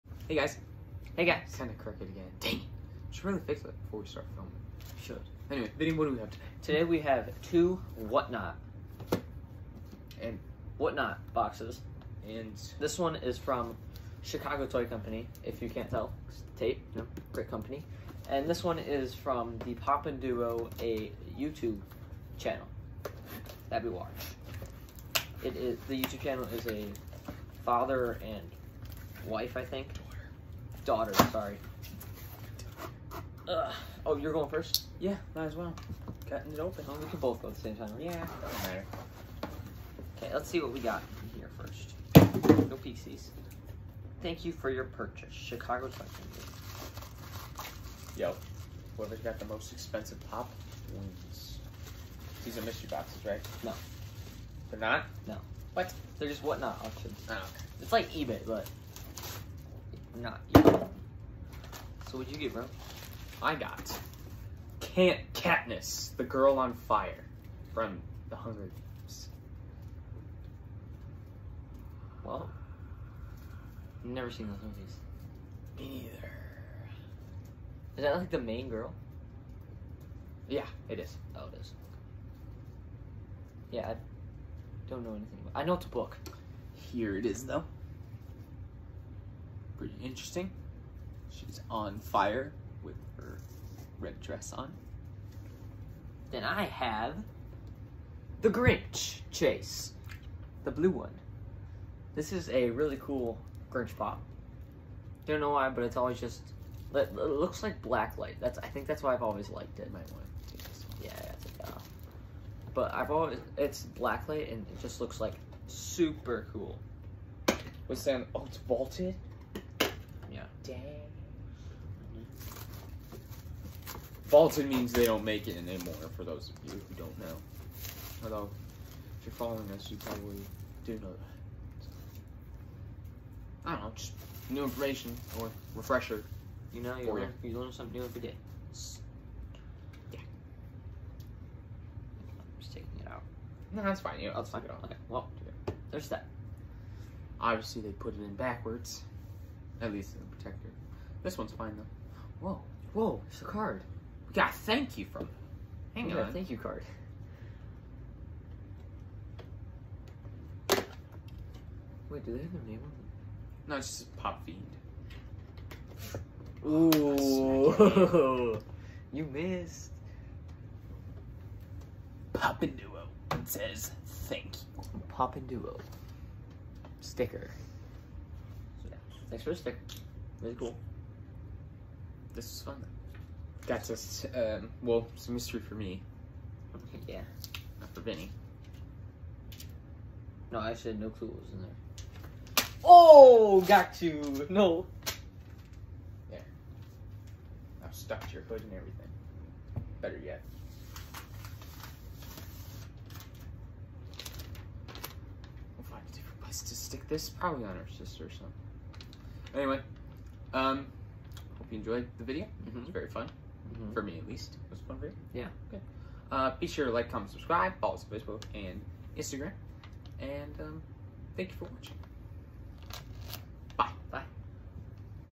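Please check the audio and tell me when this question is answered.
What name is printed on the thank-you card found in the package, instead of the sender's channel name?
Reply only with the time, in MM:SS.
02:44.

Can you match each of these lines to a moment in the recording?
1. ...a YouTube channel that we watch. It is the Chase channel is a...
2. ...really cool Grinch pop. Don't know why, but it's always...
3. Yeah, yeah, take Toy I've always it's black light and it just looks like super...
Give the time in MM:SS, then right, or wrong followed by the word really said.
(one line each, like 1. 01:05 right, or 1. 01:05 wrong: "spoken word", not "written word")
1. 00:20 wrong: "YouTube", not "Chase"
2. 01:42 right
3. 01:51 wrong: "But", not "Toy".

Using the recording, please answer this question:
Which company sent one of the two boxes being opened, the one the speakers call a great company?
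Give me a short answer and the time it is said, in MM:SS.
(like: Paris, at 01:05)
Chicago Toy Company, at 00:14.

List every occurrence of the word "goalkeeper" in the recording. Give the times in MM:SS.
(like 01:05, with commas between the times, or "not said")
not said.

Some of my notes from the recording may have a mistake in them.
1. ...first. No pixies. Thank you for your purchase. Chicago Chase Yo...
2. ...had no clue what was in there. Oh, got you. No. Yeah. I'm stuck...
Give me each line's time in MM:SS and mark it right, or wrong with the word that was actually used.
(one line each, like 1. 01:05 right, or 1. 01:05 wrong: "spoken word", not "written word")
1. 00:41 wrong: "Cycling", not "Chase"
2. 03:10 right.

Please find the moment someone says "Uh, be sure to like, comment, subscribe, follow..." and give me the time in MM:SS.
03:36.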